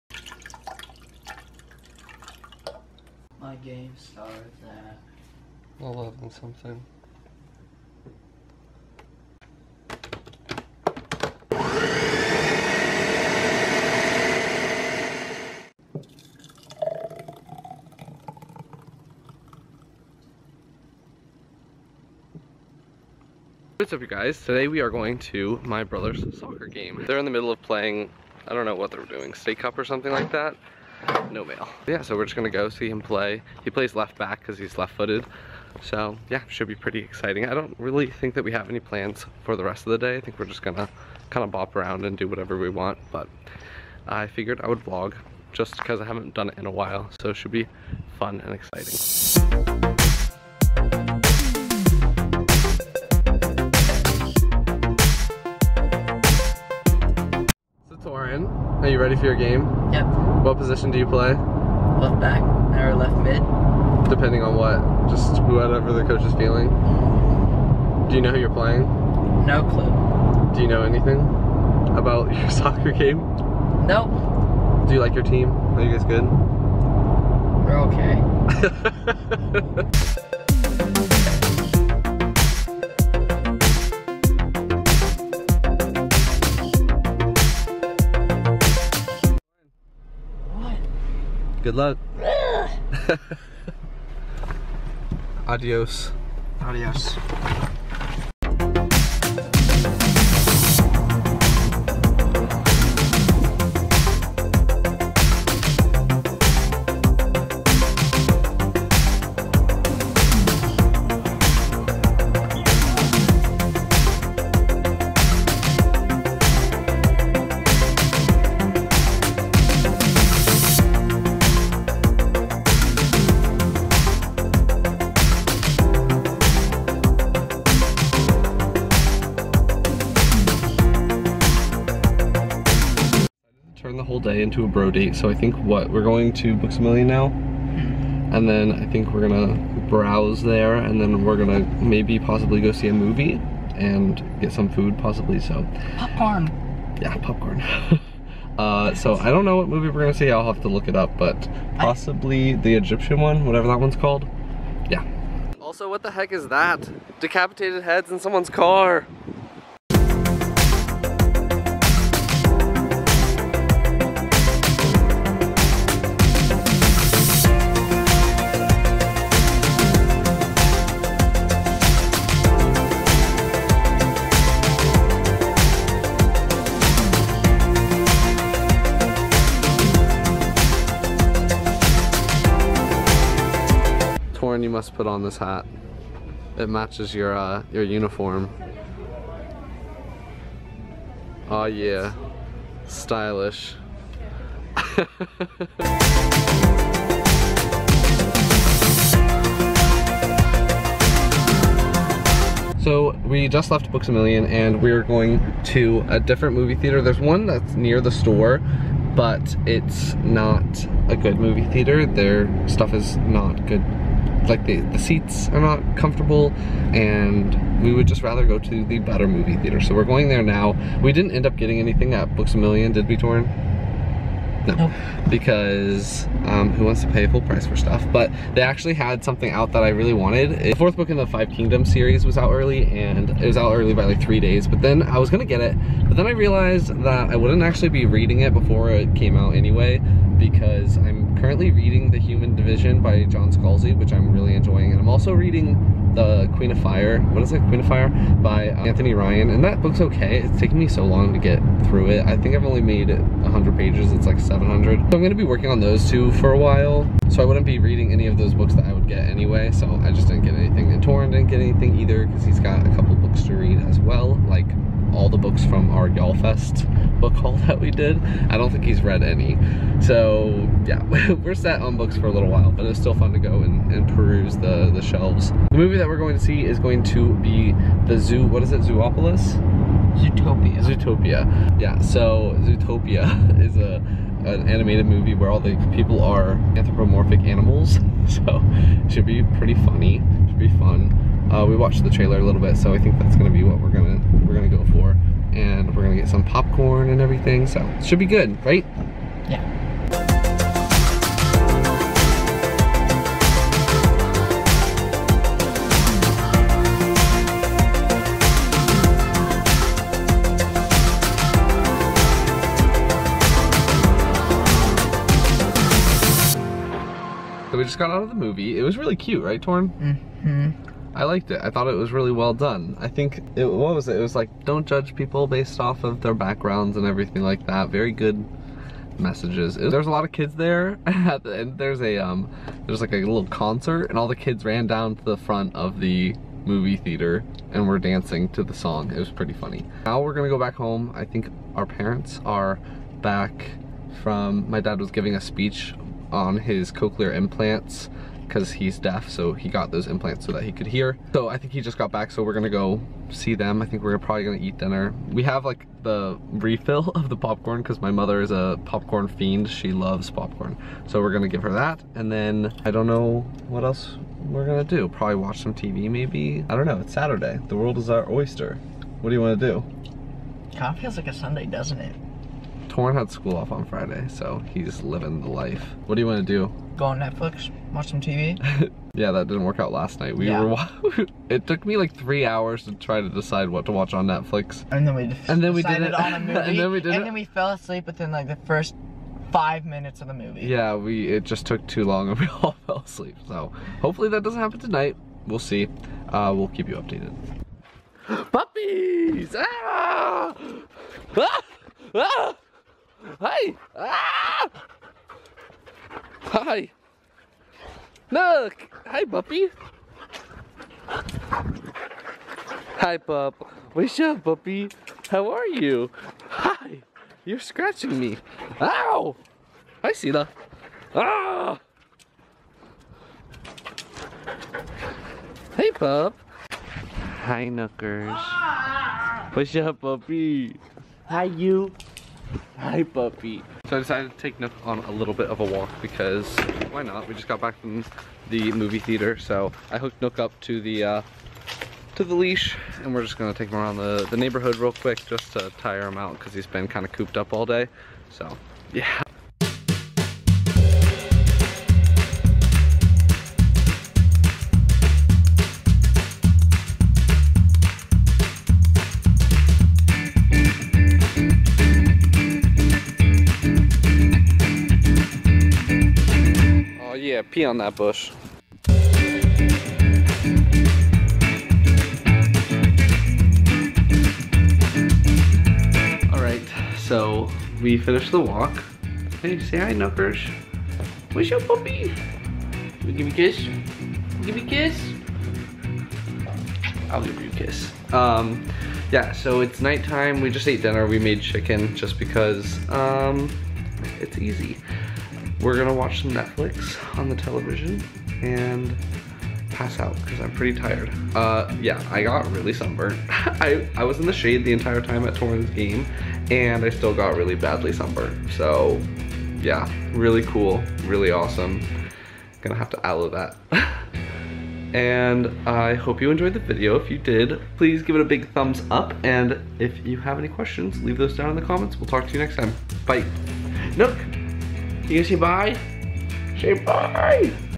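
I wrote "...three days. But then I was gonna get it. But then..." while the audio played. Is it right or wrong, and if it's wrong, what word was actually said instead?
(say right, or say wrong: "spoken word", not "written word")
right.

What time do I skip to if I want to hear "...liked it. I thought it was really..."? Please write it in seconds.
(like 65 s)
321 s.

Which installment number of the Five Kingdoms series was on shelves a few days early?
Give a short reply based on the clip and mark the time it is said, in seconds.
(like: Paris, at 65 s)
4, at 230 s.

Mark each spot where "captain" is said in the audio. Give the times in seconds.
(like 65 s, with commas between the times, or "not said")
not said.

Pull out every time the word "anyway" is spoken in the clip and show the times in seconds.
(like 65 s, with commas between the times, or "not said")
239 s, 259 s.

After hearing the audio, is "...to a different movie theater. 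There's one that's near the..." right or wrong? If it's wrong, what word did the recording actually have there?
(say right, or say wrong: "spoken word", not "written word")
right.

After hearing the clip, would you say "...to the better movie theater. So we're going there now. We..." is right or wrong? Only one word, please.
right.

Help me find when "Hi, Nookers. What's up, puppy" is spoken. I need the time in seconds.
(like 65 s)
427 s.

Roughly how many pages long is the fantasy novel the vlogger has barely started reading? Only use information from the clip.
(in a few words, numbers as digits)
700.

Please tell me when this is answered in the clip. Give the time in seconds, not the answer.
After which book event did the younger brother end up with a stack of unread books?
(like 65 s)
266 s.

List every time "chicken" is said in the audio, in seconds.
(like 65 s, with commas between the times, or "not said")
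491 s.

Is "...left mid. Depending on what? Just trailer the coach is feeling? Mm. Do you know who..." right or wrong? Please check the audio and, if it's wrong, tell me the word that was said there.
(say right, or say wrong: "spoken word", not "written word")
wrong: "whatever", not "trailer".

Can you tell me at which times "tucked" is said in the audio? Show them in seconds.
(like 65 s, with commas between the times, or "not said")
not said.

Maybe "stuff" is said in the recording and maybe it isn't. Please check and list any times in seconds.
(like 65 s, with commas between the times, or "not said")
212 s, 227 s.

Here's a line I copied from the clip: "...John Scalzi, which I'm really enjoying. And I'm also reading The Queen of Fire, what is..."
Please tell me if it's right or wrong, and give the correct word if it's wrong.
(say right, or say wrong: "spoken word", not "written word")
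right.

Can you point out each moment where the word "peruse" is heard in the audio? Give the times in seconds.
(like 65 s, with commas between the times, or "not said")
274 s.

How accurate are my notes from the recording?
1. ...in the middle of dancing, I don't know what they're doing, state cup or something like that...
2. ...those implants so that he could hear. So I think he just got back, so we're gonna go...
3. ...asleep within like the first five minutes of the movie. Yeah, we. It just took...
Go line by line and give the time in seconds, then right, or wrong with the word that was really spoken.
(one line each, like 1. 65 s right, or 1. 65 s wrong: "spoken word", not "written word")
1. 27 s wrong: "playing", not "dancing"
2. 349 s right
3. 387 s right.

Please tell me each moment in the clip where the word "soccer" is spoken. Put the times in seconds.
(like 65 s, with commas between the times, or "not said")
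26 s, 72 s.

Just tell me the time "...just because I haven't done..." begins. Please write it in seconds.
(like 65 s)
45 s.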